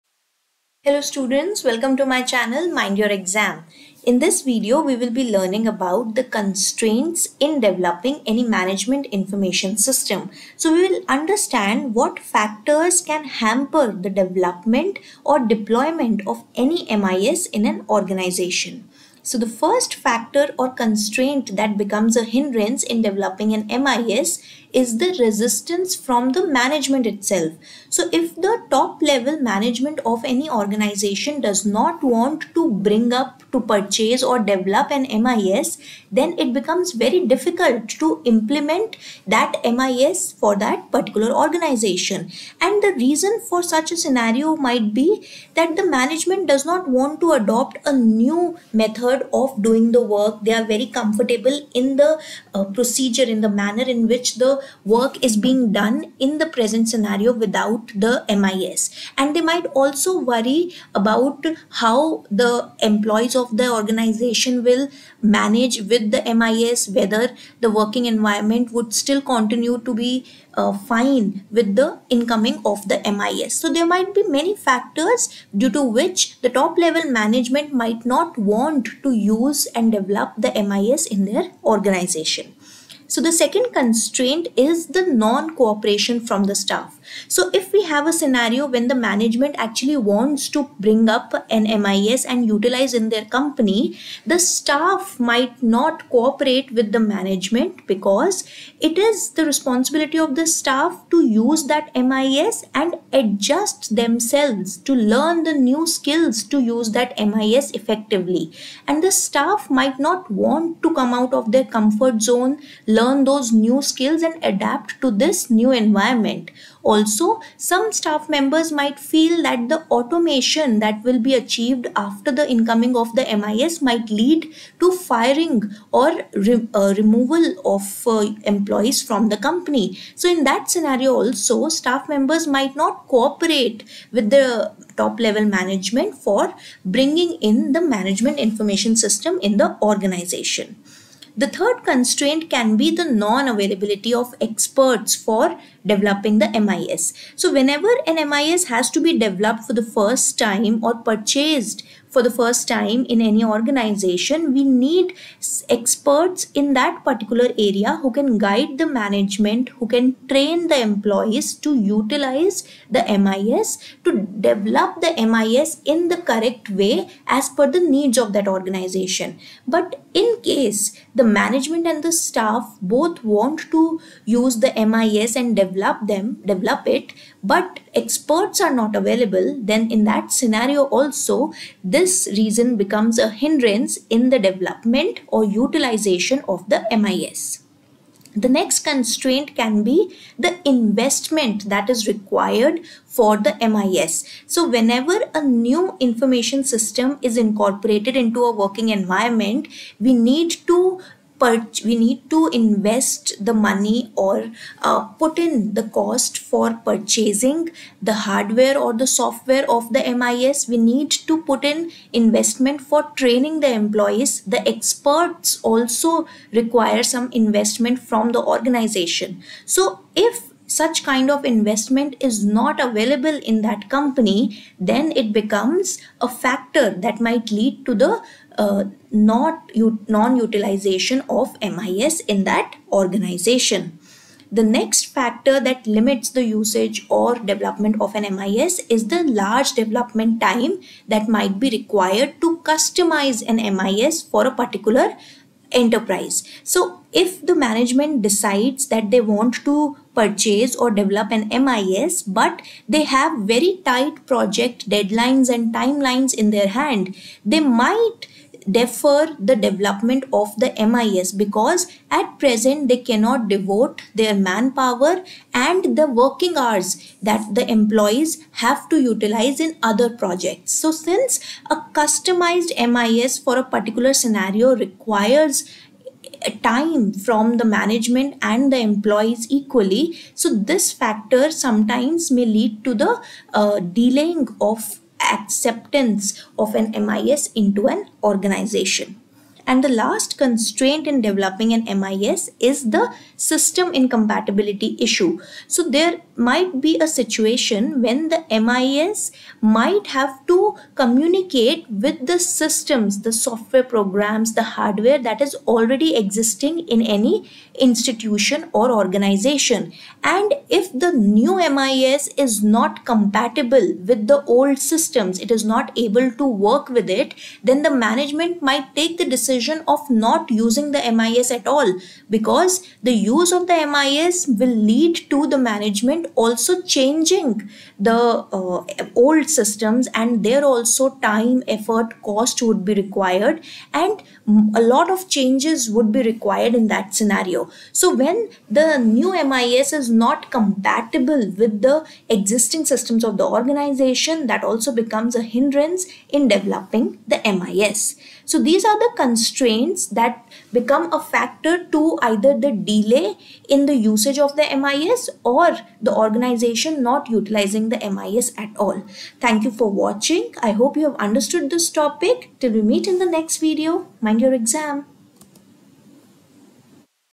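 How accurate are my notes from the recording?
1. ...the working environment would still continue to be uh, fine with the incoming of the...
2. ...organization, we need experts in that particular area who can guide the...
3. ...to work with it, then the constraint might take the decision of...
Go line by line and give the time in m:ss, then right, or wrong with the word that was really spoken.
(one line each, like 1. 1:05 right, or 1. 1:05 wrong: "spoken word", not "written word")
1. 1:07 right
2. 2:33 right
3. 5:16 wrong: "management", not "constraint".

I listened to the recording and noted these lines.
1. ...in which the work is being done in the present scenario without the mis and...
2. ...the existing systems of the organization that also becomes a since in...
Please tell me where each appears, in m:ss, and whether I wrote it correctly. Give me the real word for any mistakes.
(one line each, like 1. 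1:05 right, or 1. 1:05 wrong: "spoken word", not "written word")
1. 0:53 right
2. 5:41 wrong: "hindrance", not "since".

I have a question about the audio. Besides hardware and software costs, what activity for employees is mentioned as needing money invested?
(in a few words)
training the employees.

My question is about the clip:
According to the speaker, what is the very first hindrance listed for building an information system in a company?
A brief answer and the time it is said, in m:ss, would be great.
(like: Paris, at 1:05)
resistance from the management, at 0:25.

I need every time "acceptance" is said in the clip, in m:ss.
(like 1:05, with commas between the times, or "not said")
4:45.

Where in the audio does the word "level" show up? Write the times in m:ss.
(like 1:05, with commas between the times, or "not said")
0:29, 1:16, 2:15.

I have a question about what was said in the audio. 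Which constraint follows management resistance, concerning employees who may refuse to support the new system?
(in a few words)
non-cooperation from the staff.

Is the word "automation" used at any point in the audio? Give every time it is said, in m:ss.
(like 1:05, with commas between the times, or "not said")
1:59.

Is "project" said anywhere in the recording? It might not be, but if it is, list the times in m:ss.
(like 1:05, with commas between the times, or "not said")
4:14, 4:30.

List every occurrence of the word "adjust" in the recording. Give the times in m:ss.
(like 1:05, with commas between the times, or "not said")
1:43.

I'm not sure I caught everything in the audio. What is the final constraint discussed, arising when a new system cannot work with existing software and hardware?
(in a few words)
system incompatibility.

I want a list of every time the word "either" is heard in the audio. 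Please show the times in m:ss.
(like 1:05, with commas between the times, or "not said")
5:52.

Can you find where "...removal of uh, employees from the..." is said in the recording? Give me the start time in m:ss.
2:06.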